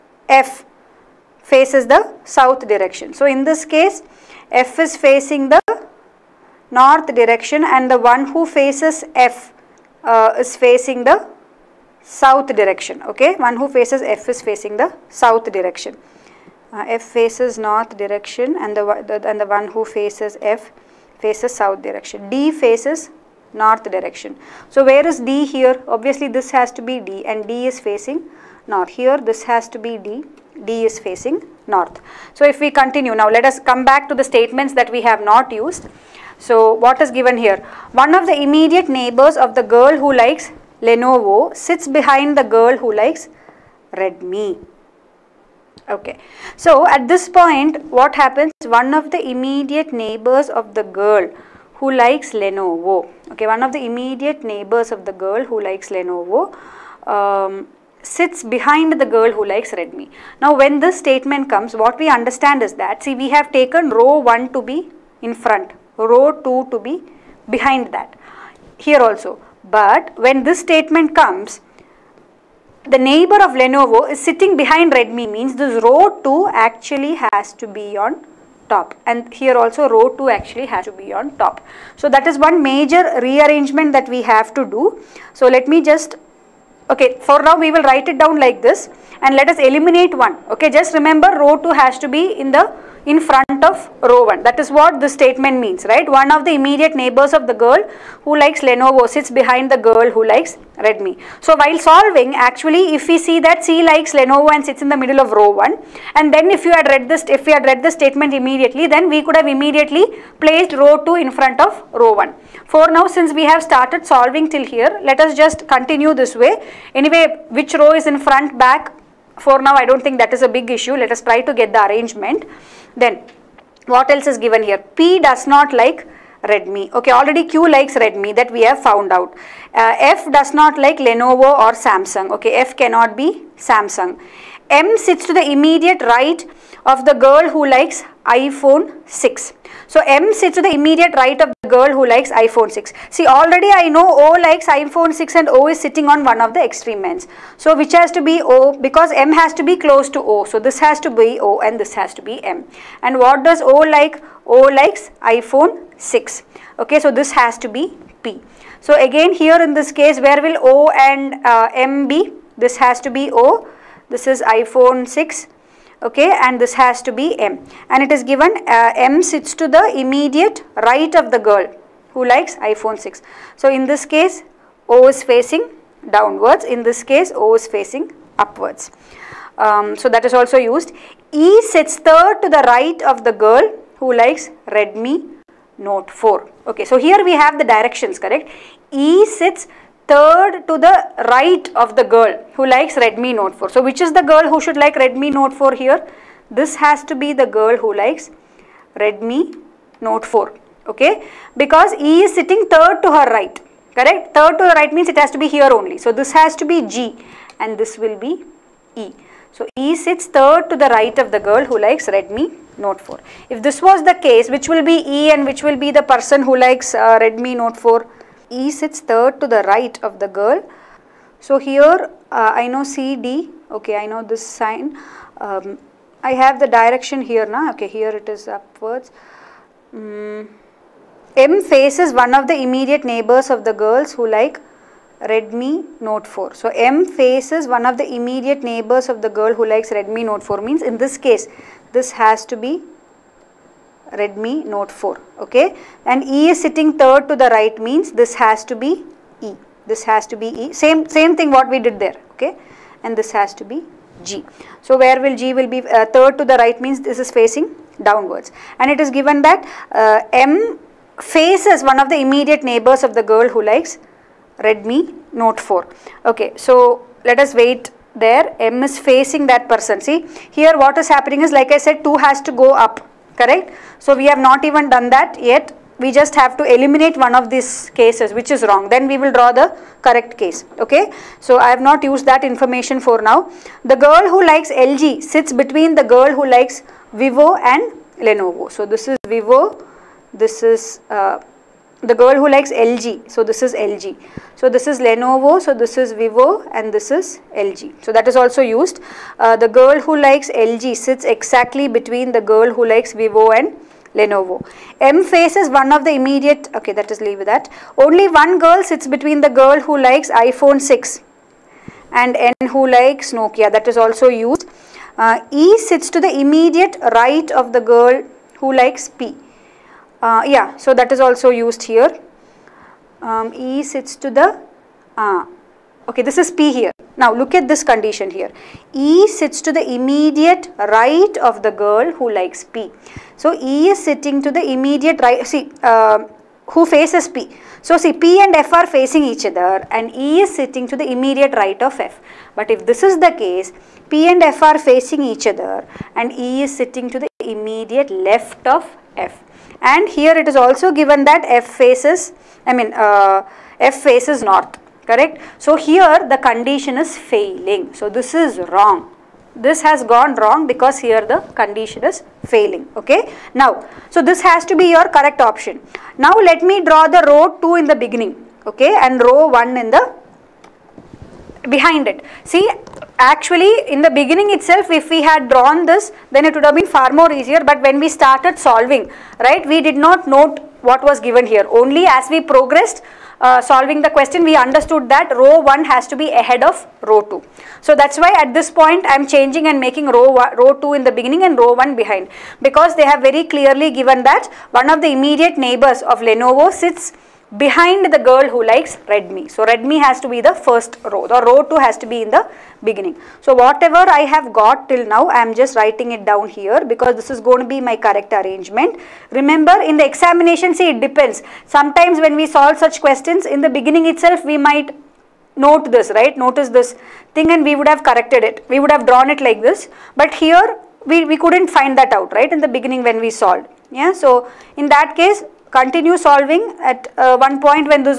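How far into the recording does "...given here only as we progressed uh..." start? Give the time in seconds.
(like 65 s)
381 s.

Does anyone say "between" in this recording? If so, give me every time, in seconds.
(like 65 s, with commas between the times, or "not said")
285 s, 301 s, 309 s.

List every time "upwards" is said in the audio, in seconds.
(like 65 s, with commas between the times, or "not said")
178 s, 228 s.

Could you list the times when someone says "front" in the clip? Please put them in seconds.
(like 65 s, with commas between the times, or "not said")
65 s, 93 s, 111 s, 118 s.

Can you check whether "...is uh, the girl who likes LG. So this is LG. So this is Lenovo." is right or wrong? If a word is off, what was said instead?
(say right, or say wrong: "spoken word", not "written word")
right.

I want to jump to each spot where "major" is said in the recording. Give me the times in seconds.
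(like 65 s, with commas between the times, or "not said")
82 s.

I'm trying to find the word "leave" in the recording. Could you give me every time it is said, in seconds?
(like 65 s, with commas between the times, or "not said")
307 s.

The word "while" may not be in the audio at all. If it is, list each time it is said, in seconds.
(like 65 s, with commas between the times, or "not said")
101 s.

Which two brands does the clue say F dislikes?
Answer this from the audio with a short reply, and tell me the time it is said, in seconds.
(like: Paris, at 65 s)
Lenovo or Samsung, at 130 s.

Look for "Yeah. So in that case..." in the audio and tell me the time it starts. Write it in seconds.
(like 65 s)
423 s.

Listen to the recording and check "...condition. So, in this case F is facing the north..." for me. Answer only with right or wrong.
wrong.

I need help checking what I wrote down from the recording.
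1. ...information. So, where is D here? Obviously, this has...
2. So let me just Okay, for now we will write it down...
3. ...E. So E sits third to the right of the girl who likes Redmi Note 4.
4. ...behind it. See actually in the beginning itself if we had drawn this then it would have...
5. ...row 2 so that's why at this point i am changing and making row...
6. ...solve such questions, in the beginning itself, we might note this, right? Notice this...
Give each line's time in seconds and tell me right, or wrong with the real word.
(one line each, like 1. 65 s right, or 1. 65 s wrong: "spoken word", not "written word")
1. 23 s wrong: "direction", not "information"
2. 85 s right
3. 208 s right
4. 371 s right
5. 387 s right
6. 412 s right.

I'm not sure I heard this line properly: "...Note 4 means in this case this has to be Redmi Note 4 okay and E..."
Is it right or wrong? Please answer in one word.
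right.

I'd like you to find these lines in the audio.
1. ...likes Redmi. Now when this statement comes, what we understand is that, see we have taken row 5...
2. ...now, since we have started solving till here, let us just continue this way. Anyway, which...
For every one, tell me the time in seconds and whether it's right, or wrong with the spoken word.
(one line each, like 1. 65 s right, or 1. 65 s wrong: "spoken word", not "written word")
1. 59 s wrong: "1", not "5"
2. 112 s right.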